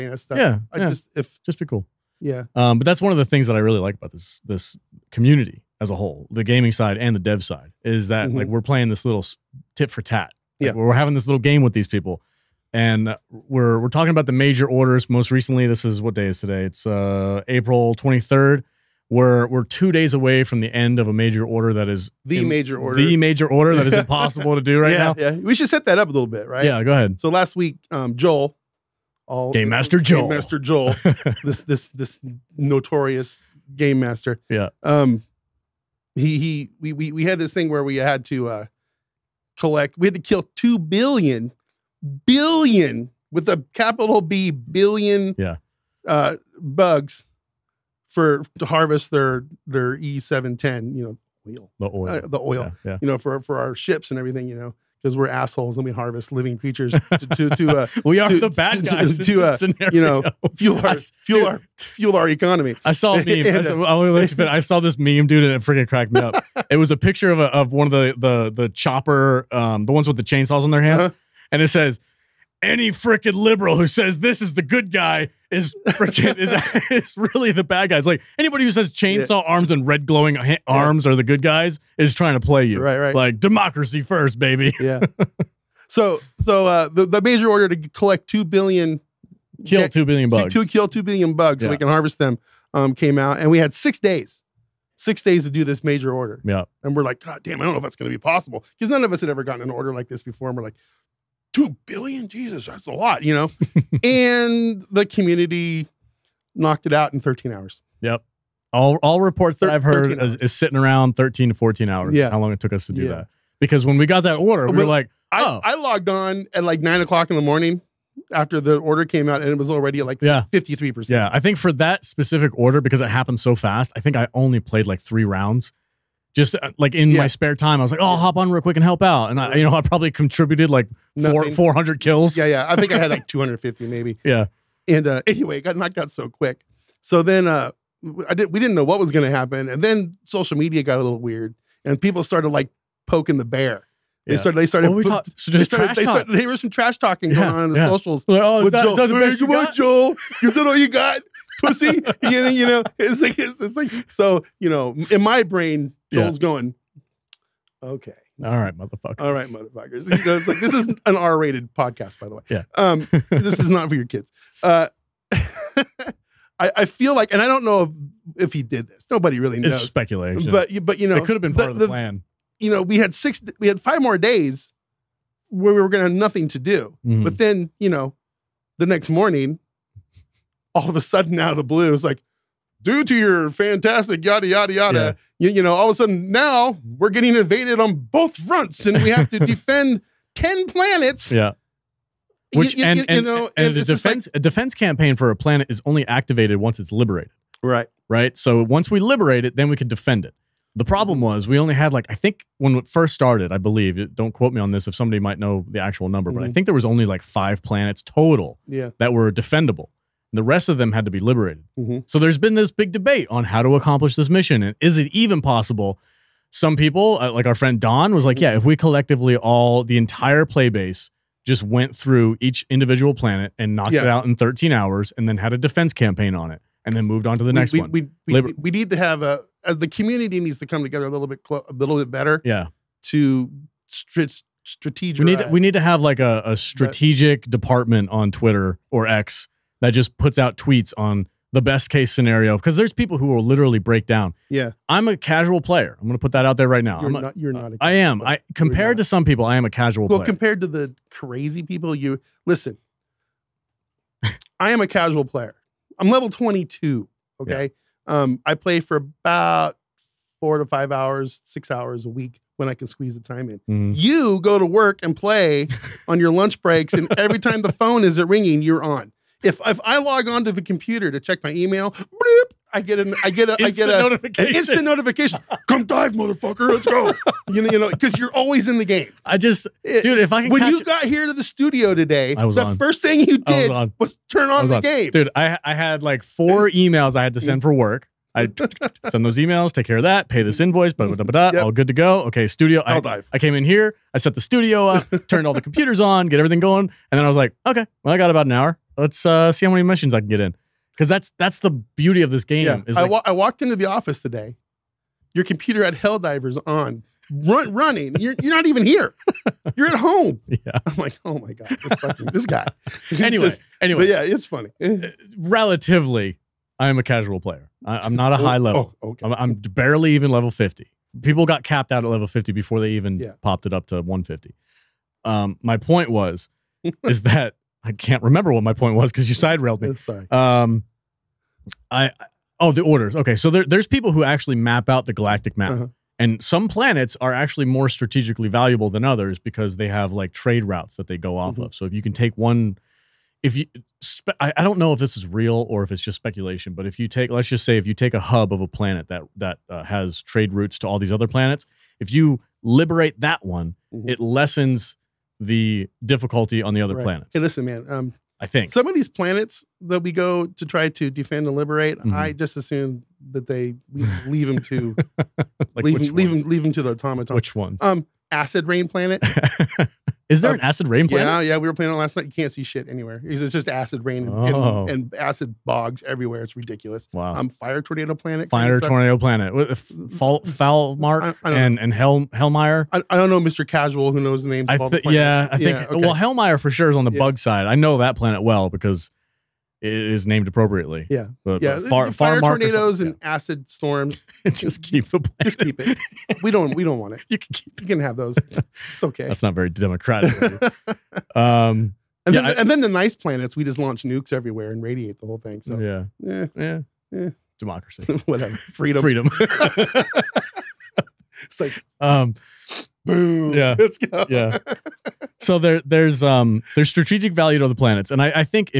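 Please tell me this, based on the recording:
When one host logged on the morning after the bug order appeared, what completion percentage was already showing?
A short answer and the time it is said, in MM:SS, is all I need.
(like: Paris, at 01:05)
53%, at 02:00.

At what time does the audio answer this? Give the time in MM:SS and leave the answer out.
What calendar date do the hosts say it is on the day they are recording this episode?
00:17.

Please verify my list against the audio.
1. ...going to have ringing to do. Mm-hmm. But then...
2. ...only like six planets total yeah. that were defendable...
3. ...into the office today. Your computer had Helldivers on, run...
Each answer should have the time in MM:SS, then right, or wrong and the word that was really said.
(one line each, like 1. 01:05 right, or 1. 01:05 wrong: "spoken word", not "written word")
1. 02:55 wrong: "nothing", not "ringing"
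2. 03:26 wrong: "five", not "six"
3. 05:03 right.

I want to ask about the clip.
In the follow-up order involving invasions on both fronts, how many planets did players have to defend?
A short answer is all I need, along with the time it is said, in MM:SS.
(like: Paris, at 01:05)
10, at 03:10.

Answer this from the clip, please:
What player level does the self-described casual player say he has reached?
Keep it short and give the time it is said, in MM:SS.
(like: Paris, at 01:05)
22, at 04:16.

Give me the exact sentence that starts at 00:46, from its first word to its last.
uh, bugs for to harvest their their E seven ten.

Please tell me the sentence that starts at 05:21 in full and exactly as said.
People got capped out at level 50 before they even yeah.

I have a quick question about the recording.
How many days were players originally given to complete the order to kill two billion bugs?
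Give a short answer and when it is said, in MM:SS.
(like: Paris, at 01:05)
6, at 01:34.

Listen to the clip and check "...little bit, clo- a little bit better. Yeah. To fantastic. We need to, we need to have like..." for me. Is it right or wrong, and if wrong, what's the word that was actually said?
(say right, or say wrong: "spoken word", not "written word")
wrong: "strategic", not "fantastic".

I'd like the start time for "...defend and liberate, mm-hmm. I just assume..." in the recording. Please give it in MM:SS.
06:01.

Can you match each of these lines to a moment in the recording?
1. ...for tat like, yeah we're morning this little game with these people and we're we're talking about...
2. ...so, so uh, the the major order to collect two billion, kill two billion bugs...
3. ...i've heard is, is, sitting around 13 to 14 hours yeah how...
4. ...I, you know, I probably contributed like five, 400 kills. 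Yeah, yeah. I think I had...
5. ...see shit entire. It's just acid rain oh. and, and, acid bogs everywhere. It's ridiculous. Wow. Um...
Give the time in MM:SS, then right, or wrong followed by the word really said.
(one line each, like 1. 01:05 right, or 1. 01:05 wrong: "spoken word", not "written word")
1. 00:09 wrong: "having", not "morning"
2. 01:25 right
3. 01:49 right
4. 02:09 wrong: "four", not "five"
5. 06:12 wrong: "anywhere", not "entire".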